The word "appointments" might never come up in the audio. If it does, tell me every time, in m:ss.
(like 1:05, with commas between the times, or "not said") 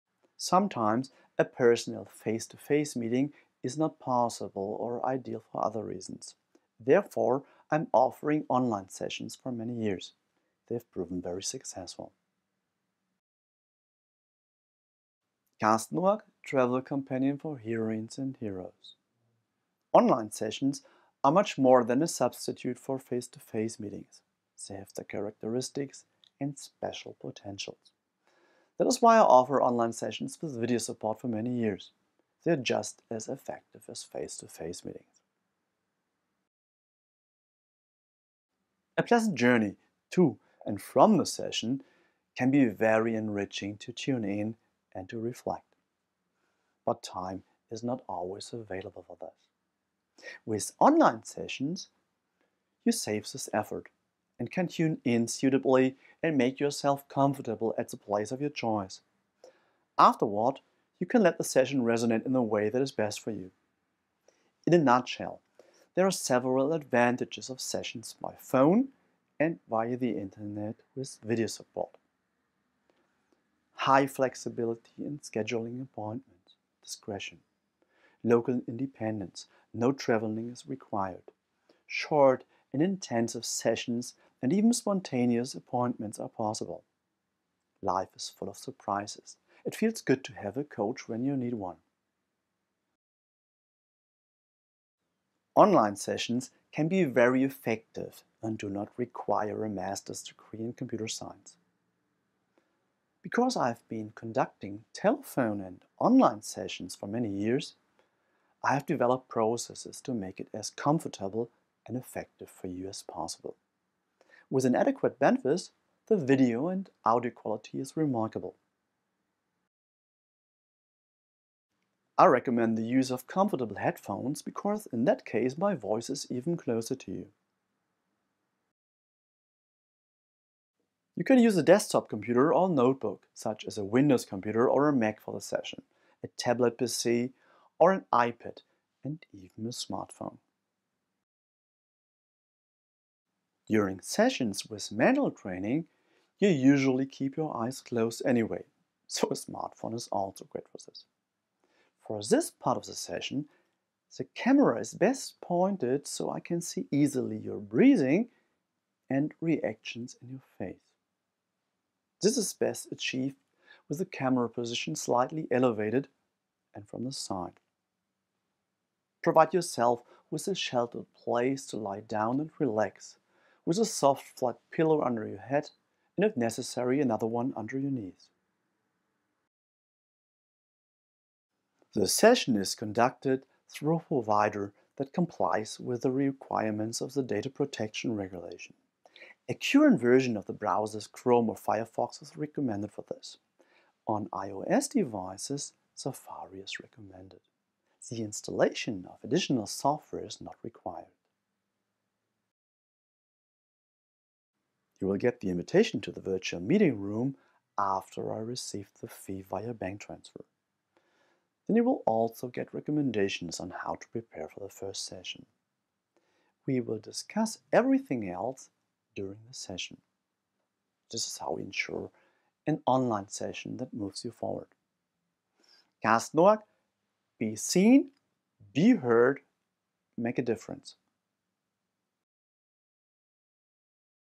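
1:15, 1:25.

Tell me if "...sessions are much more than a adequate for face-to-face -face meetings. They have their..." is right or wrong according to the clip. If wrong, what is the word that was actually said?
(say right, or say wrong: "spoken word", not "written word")
wrong: "substitute", not "adequate".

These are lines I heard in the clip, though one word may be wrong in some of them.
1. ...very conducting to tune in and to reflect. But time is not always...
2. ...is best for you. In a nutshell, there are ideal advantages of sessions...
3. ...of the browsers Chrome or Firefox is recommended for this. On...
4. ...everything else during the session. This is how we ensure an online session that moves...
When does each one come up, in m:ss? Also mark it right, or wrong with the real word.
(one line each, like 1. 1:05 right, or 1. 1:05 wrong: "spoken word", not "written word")
1. 0:42 wrong: "enriching", not "conducting"
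2. 1:02 wrong: "several", not "ideal"
3. 3:10 right
4. 3:37 right.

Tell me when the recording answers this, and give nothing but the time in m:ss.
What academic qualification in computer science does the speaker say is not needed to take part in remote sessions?
1:39.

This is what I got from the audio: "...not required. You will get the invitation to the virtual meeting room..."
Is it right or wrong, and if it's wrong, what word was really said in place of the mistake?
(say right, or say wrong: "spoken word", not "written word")
right.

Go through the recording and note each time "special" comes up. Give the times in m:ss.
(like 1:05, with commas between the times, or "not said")
0:26.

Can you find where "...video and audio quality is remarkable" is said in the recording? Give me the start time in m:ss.
1:56.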